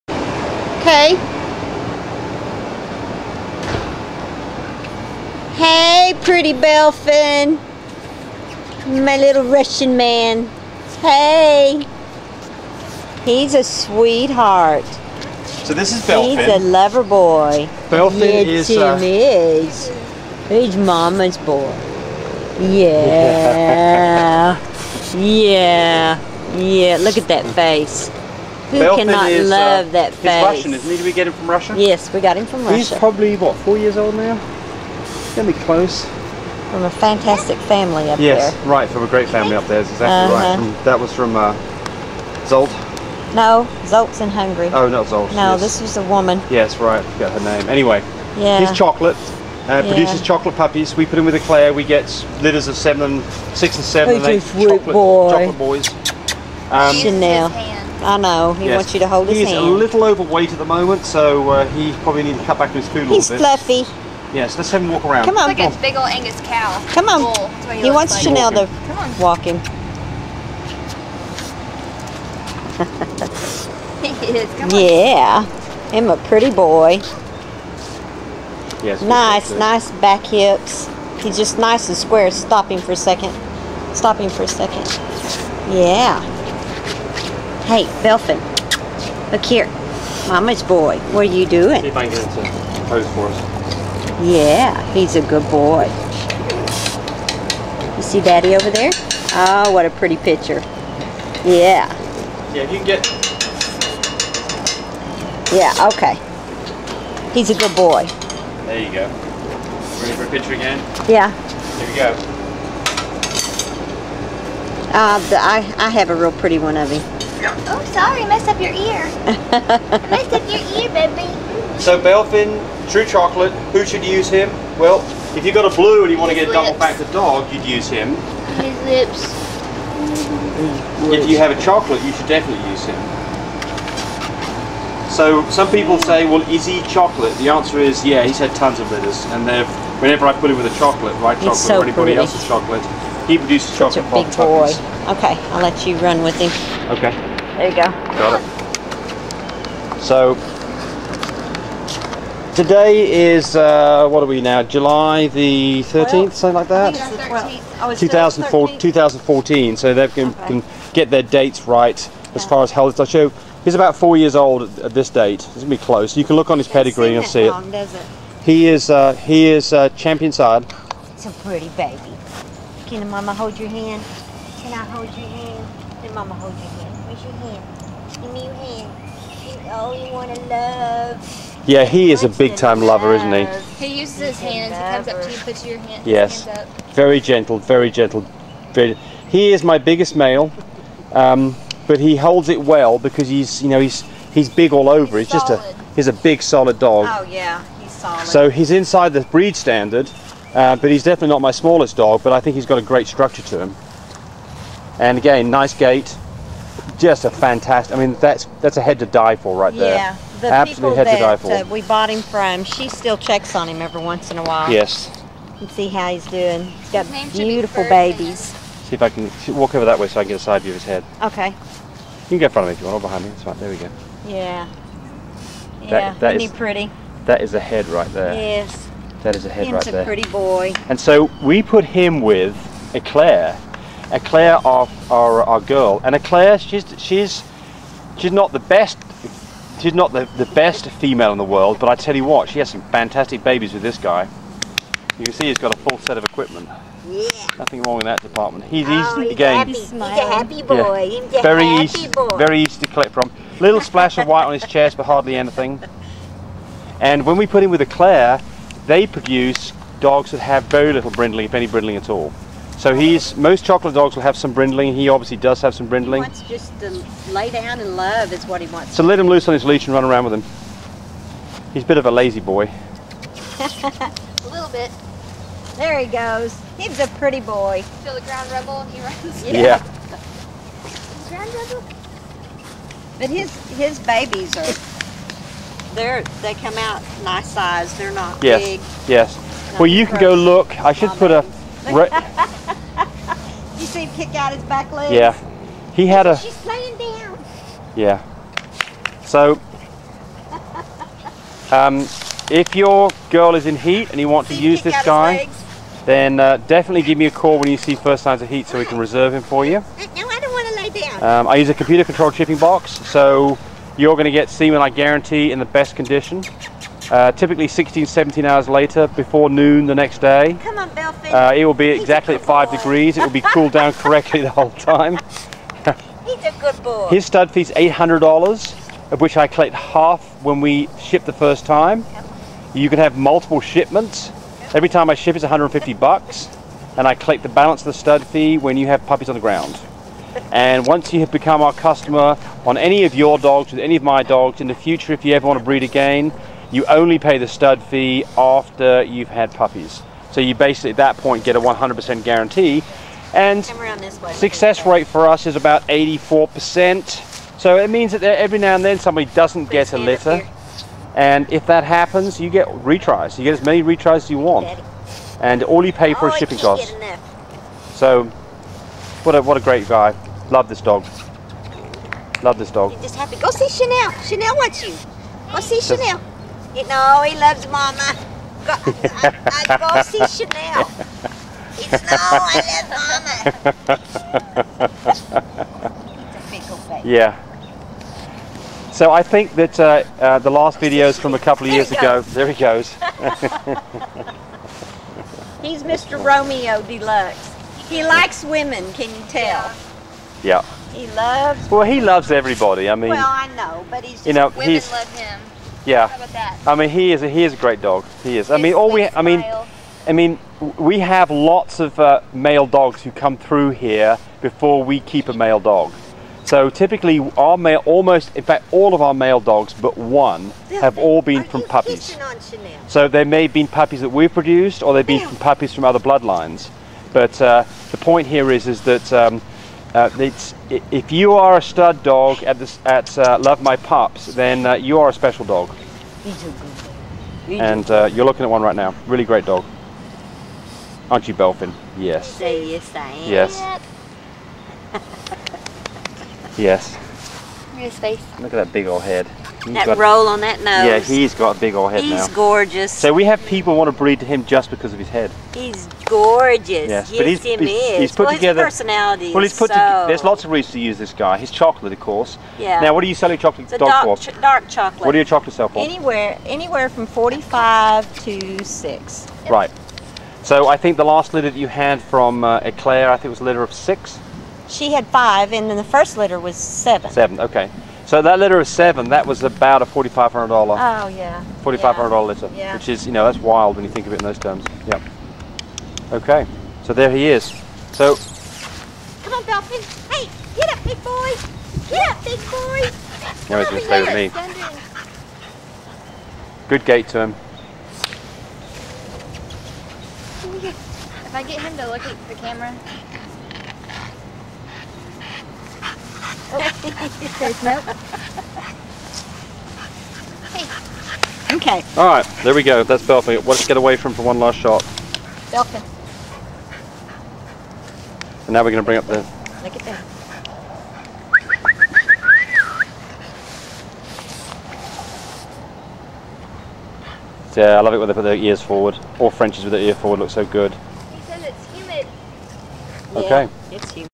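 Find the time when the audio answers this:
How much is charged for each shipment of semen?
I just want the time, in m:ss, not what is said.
5:35.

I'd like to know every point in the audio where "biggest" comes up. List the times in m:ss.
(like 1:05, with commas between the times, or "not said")
3:09.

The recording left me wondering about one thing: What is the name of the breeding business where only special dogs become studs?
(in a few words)
Love My Pups.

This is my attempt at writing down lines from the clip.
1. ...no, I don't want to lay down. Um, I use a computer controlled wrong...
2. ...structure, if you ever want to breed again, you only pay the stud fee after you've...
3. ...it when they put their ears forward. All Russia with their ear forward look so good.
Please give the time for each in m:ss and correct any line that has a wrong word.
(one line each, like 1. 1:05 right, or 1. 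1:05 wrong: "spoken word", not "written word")
1. 5:10 wrong: "shipping", not "wrong"
2. 5:44 wrong: "future", not "structure"
3. 8:47 wrong: "Frenchies", not "Russia".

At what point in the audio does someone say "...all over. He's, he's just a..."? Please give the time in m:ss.
3:14.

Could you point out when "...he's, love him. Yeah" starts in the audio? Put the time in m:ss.
6:44.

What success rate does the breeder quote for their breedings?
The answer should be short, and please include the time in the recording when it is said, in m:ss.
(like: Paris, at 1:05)
84%, at 5:55.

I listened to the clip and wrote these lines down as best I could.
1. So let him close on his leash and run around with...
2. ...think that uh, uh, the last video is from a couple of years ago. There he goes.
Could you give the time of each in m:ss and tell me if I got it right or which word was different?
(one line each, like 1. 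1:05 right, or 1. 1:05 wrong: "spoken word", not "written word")
1. 4:28 wrong: "loose", not "close"
2. 6:29 right.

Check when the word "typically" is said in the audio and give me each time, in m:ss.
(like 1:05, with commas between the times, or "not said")
5:17, 6:56.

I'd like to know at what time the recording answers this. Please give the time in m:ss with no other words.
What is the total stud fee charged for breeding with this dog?
5:27.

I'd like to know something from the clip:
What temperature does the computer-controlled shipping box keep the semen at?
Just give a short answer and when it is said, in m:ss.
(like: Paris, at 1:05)
5 degrees, at 5:21.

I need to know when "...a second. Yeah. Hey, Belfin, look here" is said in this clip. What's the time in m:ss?
1:24.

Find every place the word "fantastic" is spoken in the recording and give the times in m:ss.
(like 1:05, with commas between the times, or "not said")
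0:36, 3:27, 4:02.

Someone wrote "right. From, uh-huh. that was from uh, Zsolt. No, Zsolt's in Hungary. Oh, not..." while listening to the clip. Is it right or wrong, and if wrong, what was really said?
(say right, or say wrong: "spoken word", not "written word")
right.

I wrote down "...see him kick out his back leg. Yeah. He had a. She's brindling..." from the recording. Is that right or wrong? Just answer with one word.
wrong.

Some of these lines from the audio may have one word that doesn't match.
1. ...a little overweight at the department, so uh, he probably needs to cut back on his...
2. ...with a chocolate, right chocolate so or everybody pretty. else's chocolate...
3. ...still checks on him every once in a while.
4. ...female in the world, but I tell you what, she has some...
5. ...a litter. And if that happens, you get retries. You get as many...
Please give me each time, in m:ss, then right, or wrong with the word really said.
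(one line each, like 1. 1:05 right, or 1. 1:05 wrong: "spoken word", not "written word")
1. 0:59 wrong: "moment", not "department"
2. 2:20 wrong: "anybody", not "everybody"
3. 3:32 right
4. 4:00 right
5. 5:59 right.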